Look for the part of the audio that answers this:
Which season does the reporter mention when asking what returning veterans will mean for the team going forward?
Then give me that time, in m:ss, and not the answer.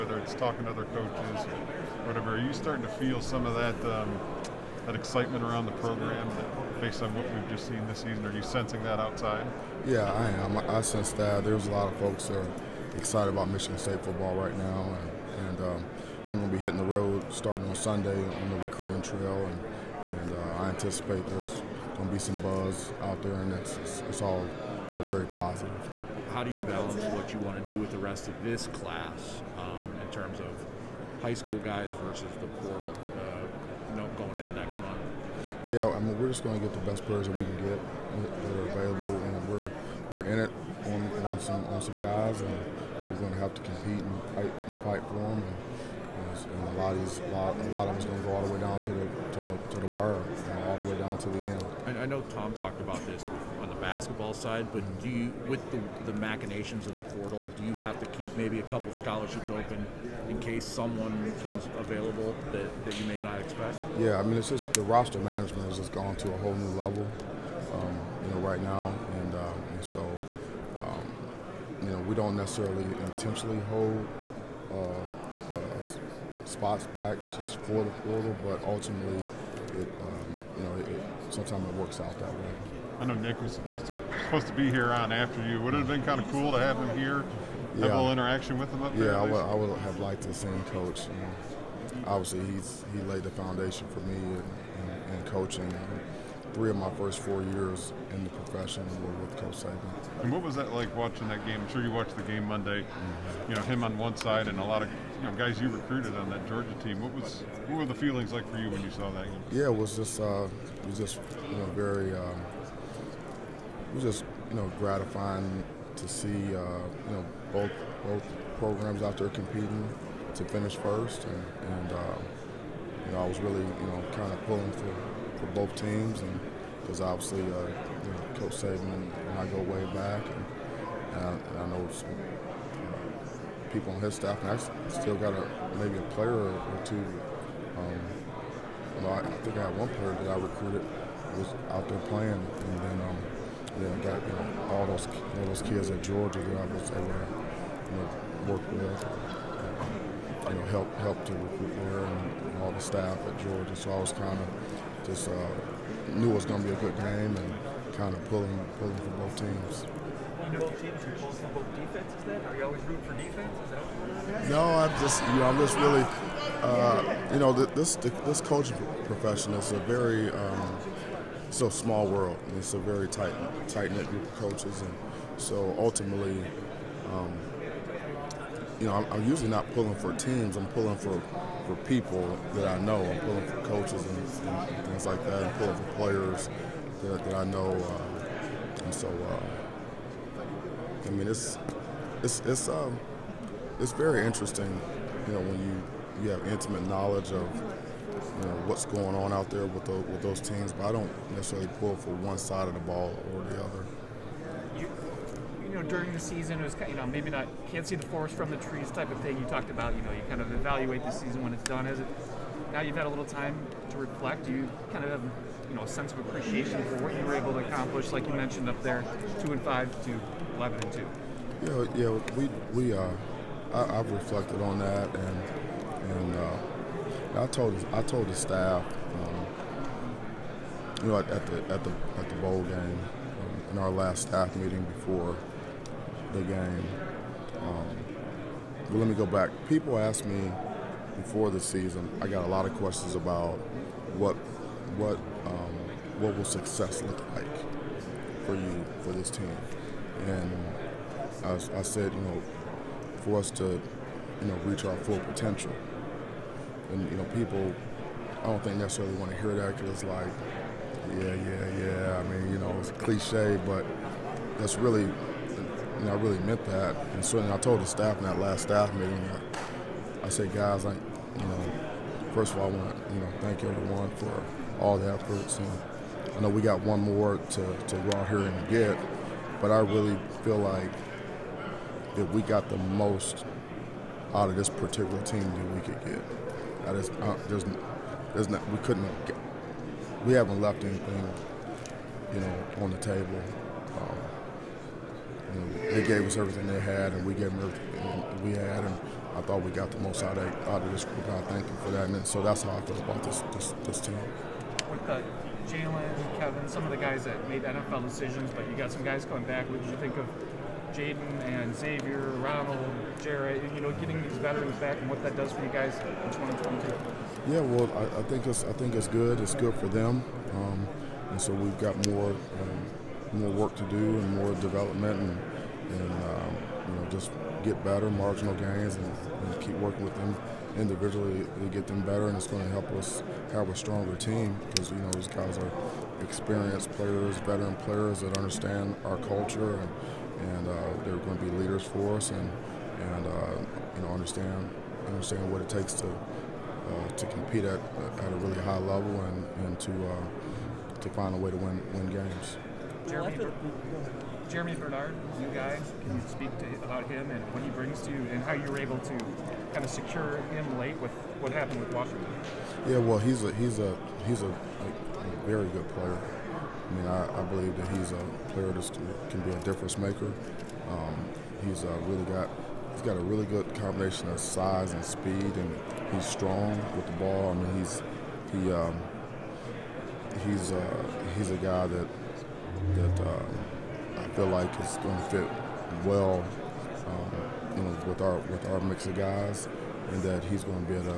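5:16.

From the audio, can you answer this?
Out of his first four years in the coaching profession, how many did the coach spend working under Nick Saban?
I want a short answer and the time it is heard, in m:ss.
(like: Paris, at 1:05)
3, at 1:36.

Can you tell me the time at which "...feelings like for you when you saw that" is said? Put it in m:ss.
1:47.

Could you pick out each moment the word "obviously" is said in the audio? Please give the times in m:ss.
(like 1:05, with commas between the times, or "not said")
1:32, 2:07.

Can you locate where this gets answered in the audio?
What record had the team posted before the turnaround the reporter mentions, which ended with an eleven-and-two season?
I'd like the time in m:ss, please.
3:39.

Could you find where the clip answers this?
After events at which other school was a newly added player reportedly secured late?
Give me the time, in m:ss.
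6:01.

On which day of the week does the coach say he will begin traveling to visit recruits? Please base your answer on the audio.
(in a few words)
Sunday.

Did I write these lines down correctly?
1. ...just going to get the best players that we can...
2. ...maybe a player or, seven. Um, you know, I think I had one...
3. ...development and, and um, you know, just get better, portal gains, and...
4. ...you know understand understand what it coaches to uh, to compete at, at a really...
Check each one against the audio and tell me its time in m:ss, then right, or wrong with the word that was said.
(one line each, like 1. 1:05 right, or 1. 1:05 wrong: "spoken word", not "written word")
1. 0:36 right
2. 2:15 wrong: "two", not "seven"
3. 5:24 wrong: "marginal", not "portal"
4. 5:43 wrong: "takes", not "coaches".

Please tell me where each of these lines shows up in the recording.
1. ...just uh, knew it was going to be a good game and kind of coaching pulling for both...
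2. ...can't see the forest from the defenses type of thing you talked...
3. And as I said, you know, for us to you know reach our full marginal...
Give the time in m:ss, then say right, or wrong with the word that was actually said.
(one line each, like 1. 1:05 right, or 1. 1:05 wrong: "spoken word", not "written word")
1. 2:35 wrong: "pulling", not "coaching"
2. 3:27 wrong: "trees", not "defenses"
3. 4:10 wrong: "potential", not "marginal".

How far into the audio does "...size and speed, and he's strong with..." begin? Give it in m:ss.
6:14.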